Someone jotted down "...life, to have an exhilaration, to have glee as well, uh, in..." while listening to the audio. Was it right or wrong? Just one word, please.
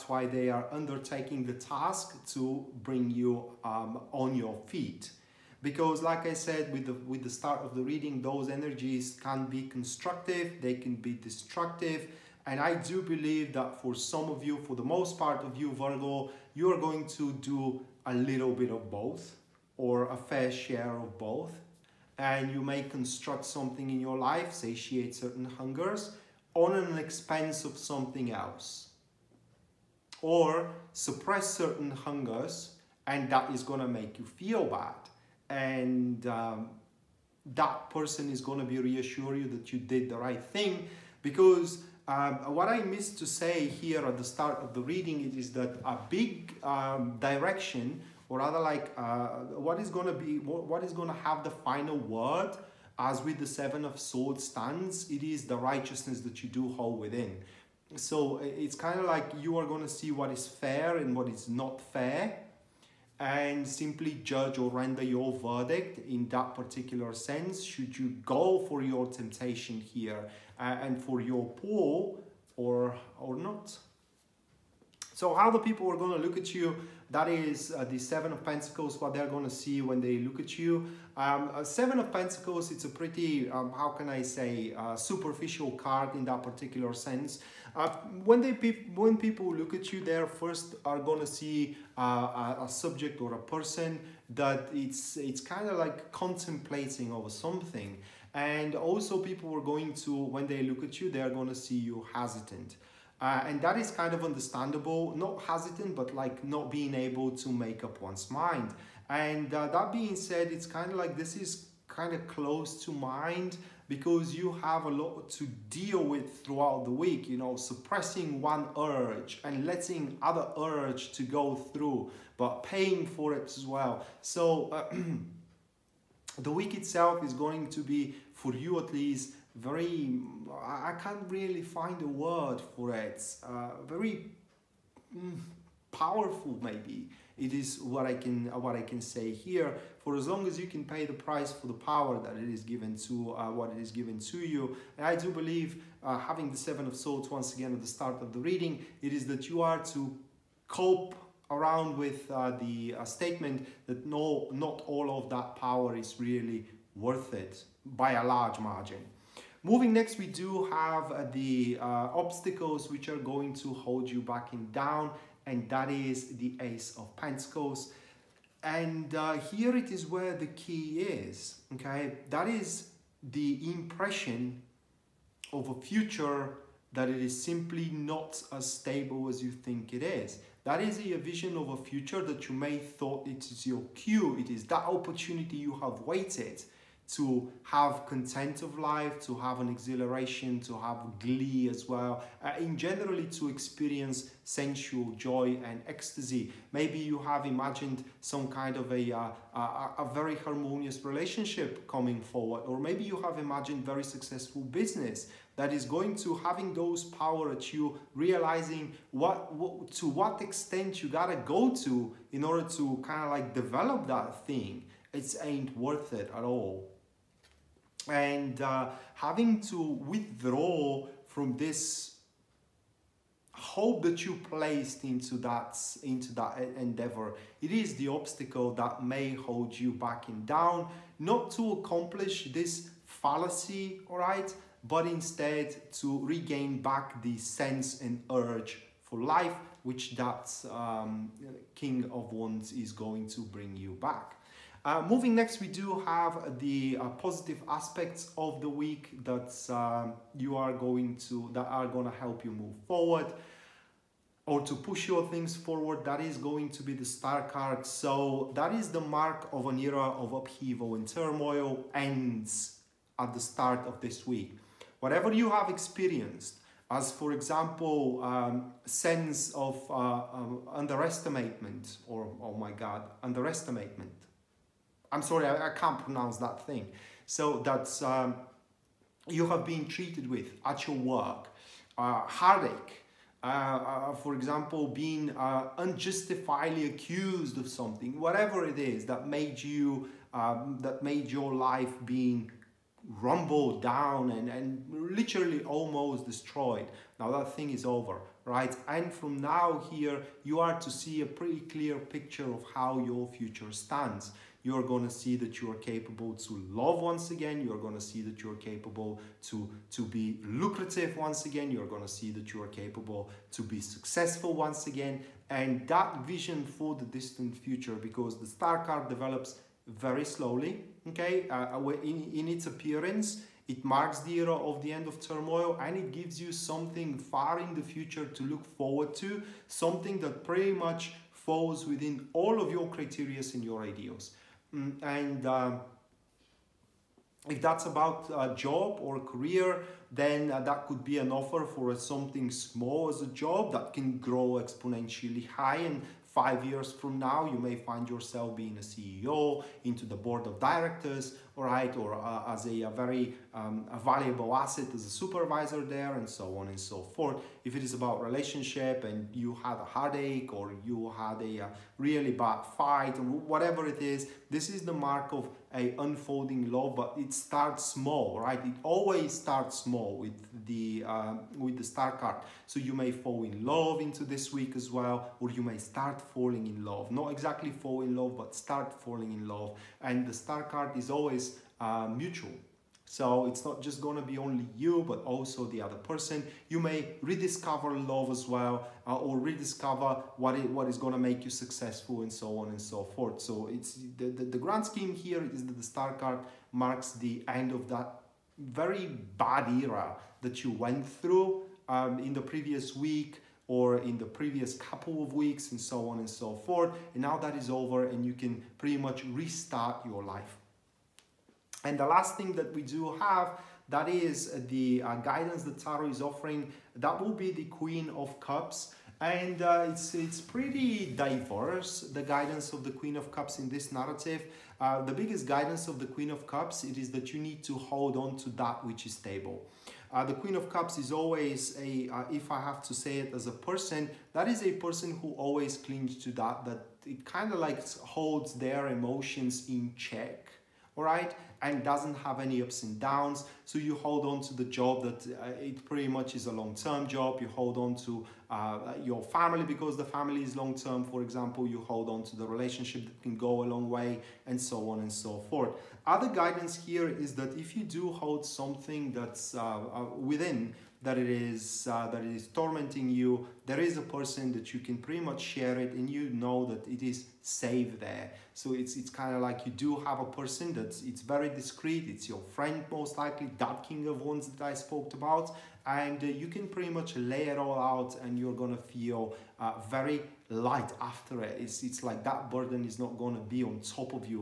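right.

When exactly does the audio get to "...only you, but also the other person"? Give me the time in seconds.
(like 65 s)
384 s.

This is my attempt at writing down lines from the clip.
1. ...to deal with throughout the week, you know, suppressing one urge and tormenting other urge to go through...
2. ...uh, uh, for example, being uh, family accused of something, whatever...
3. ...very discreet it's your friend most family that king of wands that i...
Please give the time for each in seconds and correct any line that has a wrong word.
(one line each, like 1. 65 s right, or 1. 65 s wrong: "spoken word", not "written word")
1. 115 s wrong: "letting", not "tormenting"
2. 283 s wrong: "unjustifiably", not "family"
3. 471 s wrong: "likely", not "family".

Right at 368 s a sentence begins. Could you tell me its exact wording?
It always starts small with the uh, with the star card.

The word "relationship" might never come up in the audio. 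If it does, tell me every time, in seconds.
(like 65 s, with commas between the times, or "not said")
201 s, 358 s, 452 s.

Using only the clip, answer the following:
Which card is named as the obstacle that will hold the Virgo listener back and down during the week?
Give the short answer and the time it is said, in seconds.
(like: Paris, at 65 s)
Ace of Pentacles, at 166 s.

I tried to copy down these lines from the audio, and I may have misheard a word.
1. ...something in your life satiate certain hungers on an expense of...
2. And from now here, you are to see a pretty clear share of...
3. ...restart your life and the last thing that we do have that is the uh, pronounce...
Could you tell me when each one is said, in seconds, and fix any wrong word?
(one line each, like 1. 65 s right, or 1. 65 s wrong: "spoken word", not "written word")
1. 23 s right
2. 298 s wrong: "picture", not "share"
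3. 409 s wrong: "guidance", not "pronounce".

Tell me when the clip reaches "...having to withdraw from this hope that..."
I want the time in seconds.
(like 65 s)
219 s.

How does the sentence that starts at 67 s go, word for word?
Should you go for your temptation here uh, and for your pull or, or not?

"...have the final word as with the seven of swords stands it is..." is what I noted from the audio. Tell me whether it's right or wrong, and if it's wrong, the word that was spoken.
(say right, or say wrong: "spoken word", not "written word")
right.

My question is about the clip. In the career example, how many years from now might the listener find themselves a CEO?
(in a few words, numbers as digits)
5.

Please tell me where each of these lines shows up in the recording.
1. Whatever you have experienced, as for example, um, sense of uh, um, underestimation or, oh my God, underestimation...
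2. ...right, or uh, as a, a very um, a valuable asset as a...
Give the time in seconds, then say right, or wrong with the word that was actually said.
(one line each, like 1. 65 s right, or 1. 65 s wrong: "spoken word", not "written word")
1. 265 s right
2. 351 s right.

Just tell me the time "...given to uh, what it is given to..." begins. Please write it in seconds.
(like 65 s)
142 s.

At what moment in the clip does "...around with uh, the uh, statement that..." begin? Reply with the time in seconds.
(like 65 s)
151 s.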